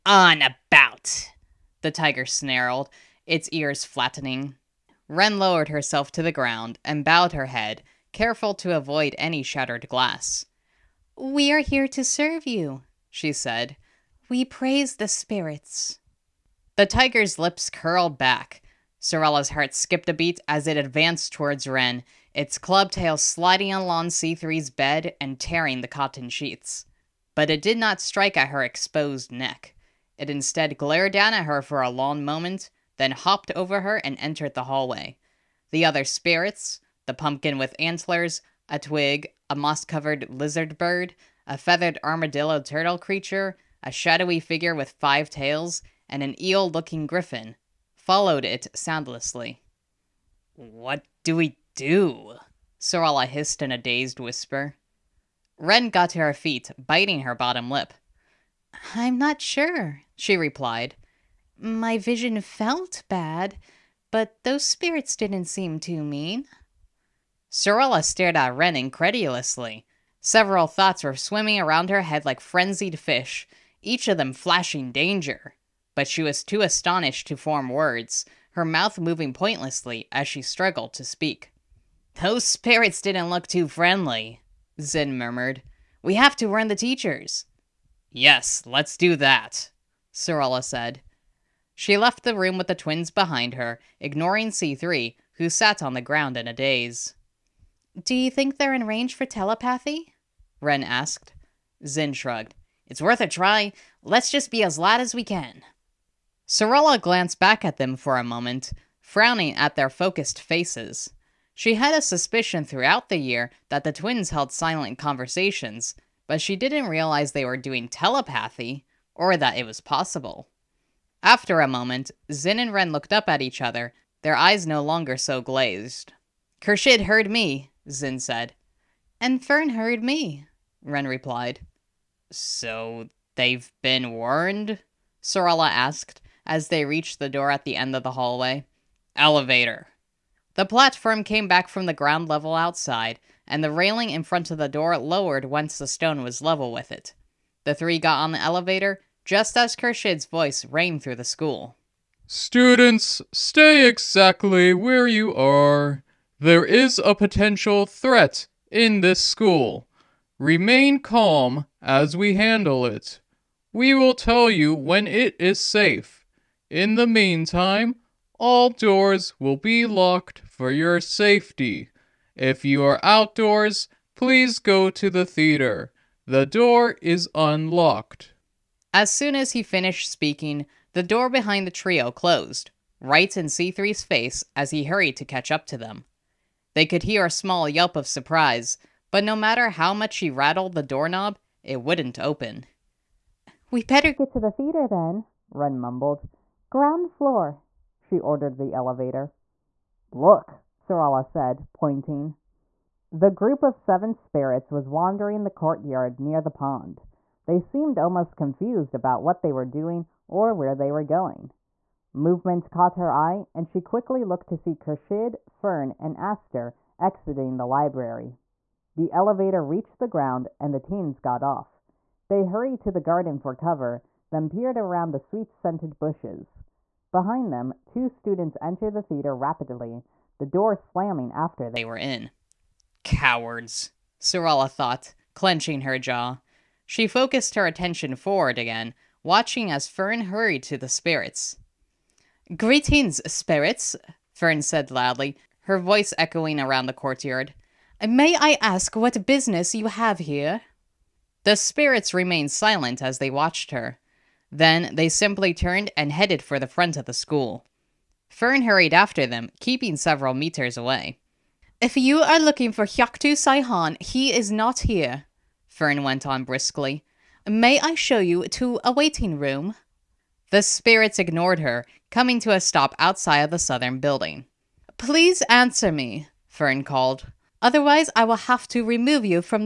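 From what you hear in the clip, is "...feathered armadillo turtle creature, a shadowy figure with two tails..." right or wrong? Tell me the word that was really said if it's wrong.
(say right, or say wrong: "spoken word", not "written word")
wrong: "five", not "two".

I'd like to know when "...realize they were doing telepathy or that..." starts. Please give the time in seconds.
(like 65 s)
116 s.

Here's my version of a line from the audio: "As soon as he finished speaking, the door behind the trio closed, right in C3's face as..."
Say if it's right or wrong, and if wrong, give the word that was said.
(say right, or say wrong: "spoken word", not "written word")
right.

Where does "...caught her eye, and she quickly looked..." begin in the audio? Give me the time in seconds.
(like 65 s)
212 s.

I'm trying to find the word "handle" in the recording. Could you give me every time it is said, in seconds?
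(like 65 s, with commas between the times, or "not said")
162 s.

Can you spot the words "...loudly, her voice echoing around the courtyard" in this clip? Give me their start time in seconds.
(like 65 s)
244 s.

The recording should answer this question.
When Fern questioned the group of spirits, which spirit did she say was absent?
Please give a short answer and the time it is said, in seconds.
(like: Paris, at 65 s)
Hyaktu Saihan, at 262 s.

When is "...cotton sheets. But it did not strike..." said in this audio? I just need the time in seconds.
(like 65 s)
25 s.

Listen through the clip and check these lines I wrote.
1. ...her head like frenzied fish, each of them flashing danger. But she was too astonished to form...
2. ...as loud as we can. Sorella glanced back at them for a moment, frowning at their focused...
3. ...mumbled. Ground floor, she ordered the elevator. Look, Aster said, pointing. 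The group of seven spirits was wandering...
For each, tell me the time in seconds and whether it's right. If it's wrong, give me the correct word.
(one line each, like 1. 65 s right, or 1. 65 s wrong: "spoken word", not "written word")
1. 71 s right
2. 104 s right
3. 195 s wrong: "Sarala", not "Aster".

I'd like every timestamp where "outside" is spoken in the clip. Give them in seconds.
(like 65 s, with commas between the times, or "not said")
142 s, 272 s.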